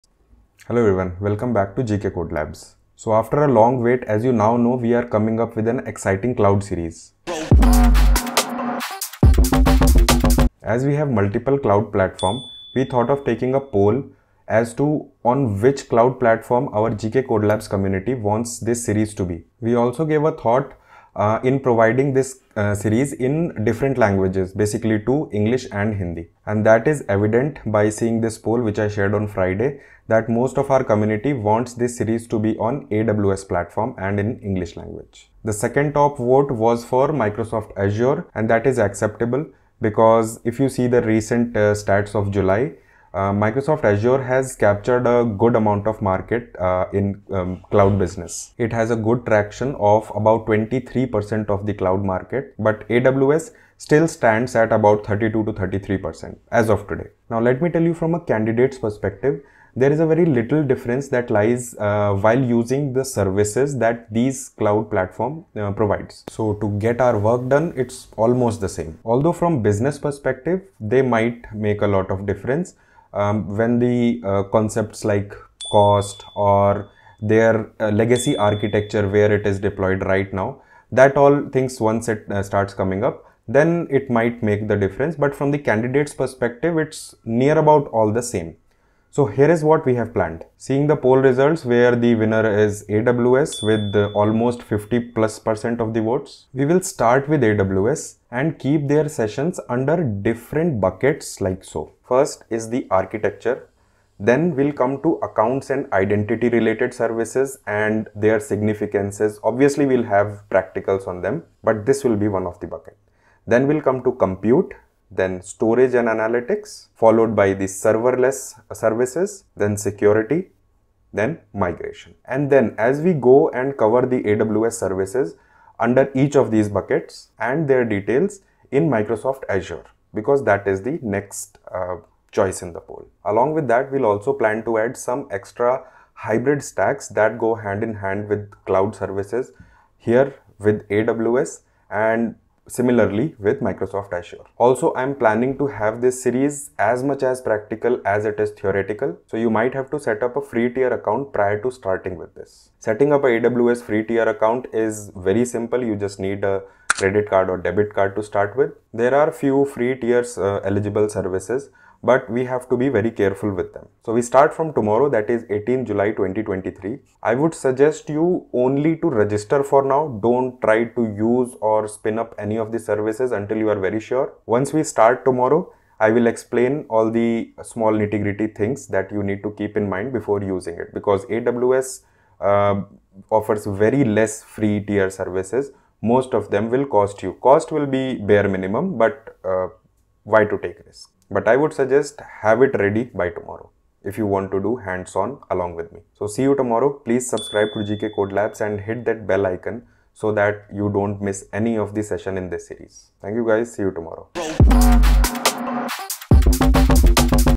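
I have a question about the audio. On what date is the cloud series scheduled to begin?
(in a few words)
18 July 2023.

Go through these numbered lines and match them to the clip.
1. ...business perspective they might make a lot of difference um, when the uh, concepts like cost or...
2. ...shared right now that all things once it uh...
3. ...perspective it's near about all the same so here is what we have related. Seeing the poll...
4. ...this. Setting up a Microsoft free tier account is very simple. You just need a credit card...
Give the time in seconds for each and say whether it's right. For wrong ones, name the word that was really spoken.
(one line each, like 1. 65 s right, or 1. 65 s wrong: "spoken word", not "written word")
1. 69 s right
2. 79 s wrong: "deployed", not "shared"
3. 86 s wrong: "planned", not "related"
4. 152 s wrong: "AWS", not "Microsoft".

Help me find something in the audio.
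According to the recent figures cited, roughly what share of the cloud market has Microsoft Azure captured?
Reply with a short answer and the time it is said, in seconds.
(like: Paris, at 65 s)
23%, at 50 s.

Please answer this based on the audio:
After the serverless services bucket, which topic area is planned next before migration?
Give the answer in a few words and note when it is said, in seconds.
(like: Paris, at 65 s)
security, at 119 s.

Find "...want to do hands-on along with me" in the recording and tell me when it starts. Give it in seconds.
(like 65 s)
194 s.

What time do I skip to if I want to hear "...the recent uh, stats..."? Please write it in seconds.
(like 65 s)
40 s.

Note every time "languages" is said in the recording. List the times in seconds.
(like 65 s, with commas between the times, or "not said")
23 s, 34 s.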